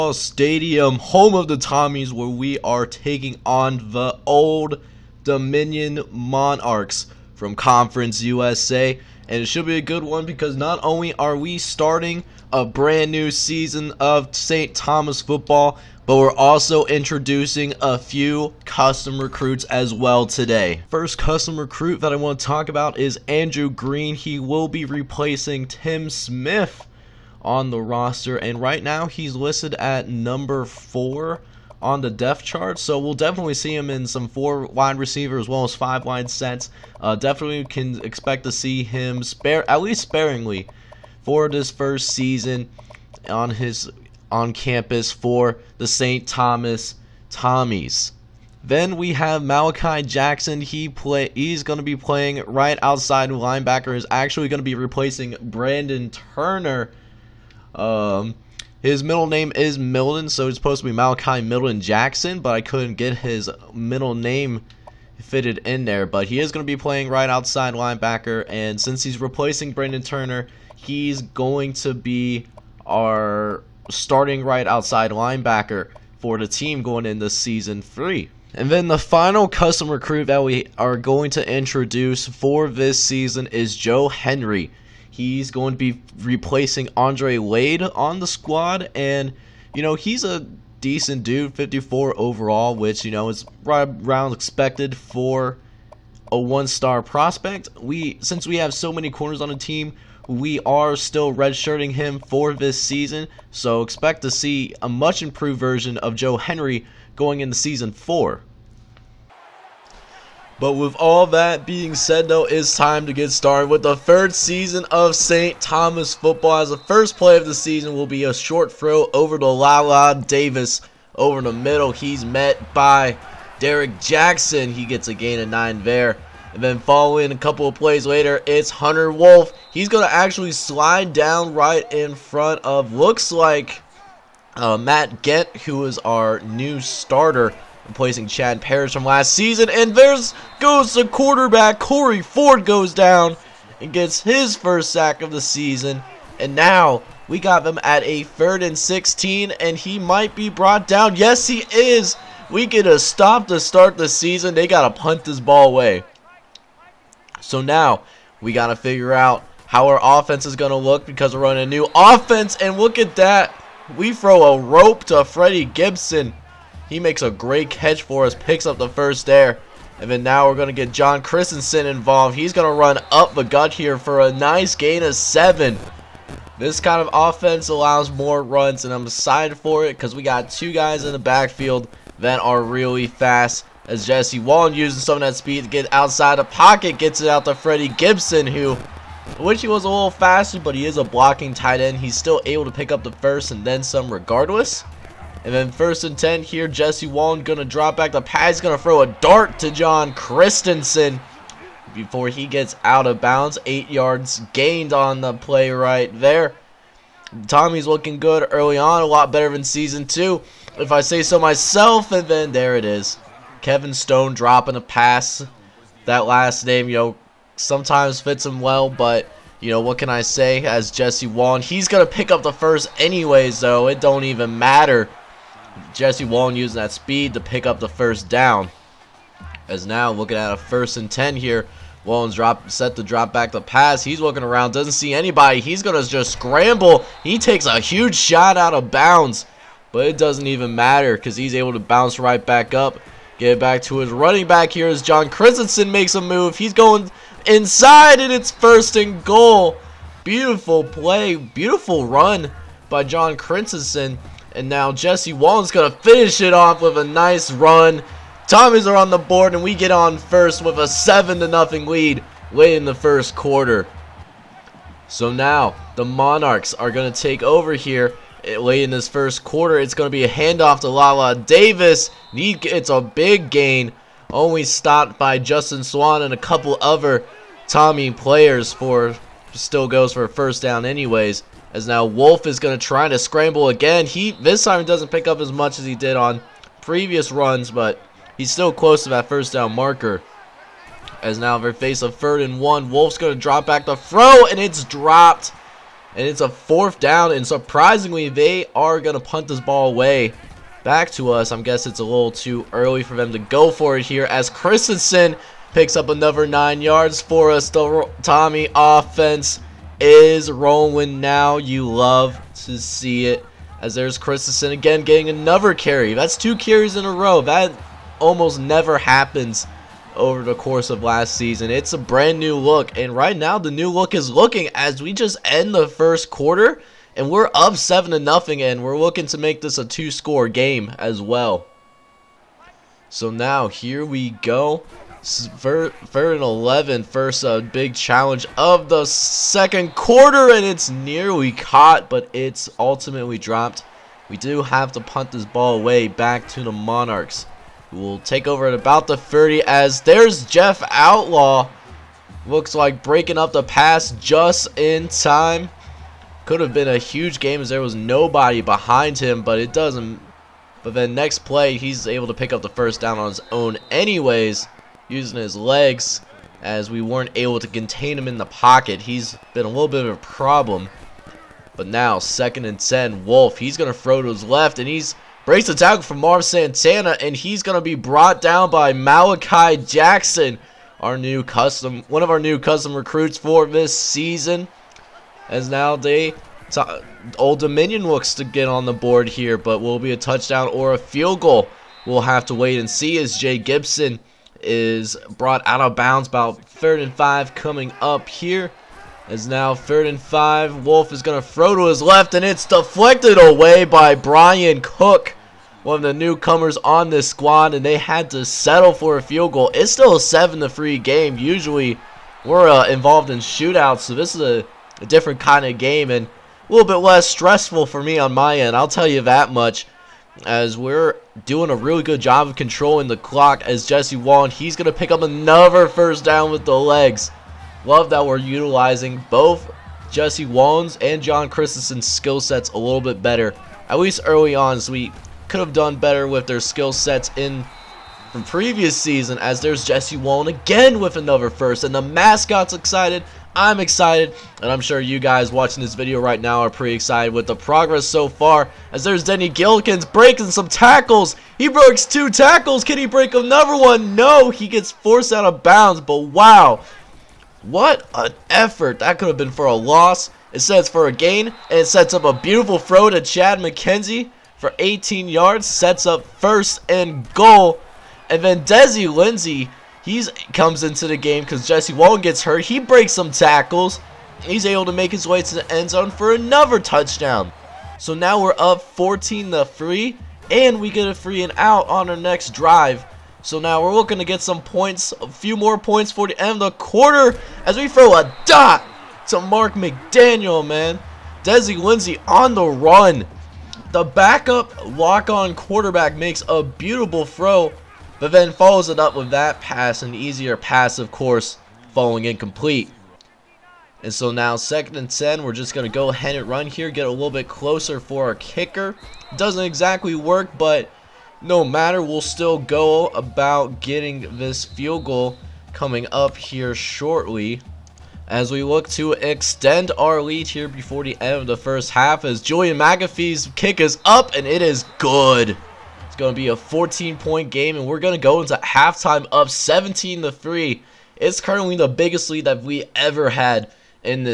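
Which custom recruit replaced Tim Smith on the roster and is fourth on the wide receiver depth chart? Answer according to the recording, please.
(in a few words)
Andrew Green.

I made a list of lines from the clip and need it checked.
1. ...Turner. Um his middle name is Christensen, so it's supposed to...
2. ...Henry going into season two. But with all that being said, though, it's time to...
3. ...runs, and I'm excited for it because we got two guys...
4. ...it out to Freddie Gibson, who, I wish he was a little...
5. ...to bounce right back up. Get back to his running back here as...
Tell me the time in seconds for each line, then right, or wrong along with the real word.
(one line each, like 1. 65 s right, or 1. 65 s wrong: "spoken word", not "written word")
1. 56 s wrong: "Milton", not "Christensen"
2. 106 s wrong: "four", not "two"
3. 178 s right
4. 187 s right
5. 241 s right.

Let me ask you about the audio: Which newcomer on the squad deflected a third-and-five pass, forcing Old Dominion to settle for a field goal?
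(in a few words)
Brian Cook.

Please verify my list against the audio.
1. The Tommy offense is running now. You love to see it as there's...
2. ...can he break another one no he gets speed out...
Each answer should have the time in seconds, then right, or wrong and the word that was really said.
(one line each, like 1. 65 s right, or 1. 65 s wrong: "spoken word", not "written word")
1. 307 s wrong: "rolling", not "running"
2. 452 s wrong: "forced", not "speed".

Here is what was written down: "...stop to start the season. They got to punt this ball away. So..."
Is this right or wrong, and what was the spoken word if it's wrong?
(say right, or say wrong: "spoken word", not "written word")
right.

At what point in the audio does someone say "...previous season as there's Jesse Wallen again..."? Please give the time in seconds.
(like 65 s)
438 s.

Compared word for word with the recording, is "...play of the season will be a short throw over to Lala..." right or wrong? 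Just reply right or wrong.
right.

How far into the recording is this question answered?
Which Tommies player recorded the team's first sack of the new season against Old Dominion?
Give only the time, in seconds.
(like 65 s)
141 s.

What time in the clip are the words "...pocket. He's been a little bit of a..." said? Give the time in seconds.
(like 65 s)
368 s.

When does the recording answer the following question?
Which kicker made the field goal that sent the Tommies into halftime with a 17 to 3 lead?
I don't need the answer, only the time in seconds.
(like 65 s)
522 s.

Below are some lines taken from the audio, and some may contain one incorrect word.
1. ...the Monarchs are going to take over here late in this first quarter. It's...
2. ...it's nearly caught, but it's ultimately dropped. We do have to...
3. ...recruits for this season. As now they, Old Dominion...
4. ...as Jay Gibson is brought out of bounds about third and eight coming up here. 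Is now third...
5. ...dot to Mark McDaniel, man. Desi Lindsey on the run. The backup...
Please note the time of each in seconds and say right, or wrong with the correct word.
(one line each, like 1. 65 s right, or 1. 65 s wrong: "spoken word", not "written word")
1. 265 s right
2. 340 s right
3. 382 s right
4. 393 s wrong: "five", not "eight"
5. 488 s right.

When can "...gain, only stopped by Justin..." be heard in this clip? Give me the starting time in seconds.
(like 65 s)
273 s.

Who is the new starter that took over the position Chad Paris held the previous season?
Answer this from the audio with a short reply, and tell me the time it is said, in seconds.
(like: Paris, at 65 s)
Matt Gent, at 134 s.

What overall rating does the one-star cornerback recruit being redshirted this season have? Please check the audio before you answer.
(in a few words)
54.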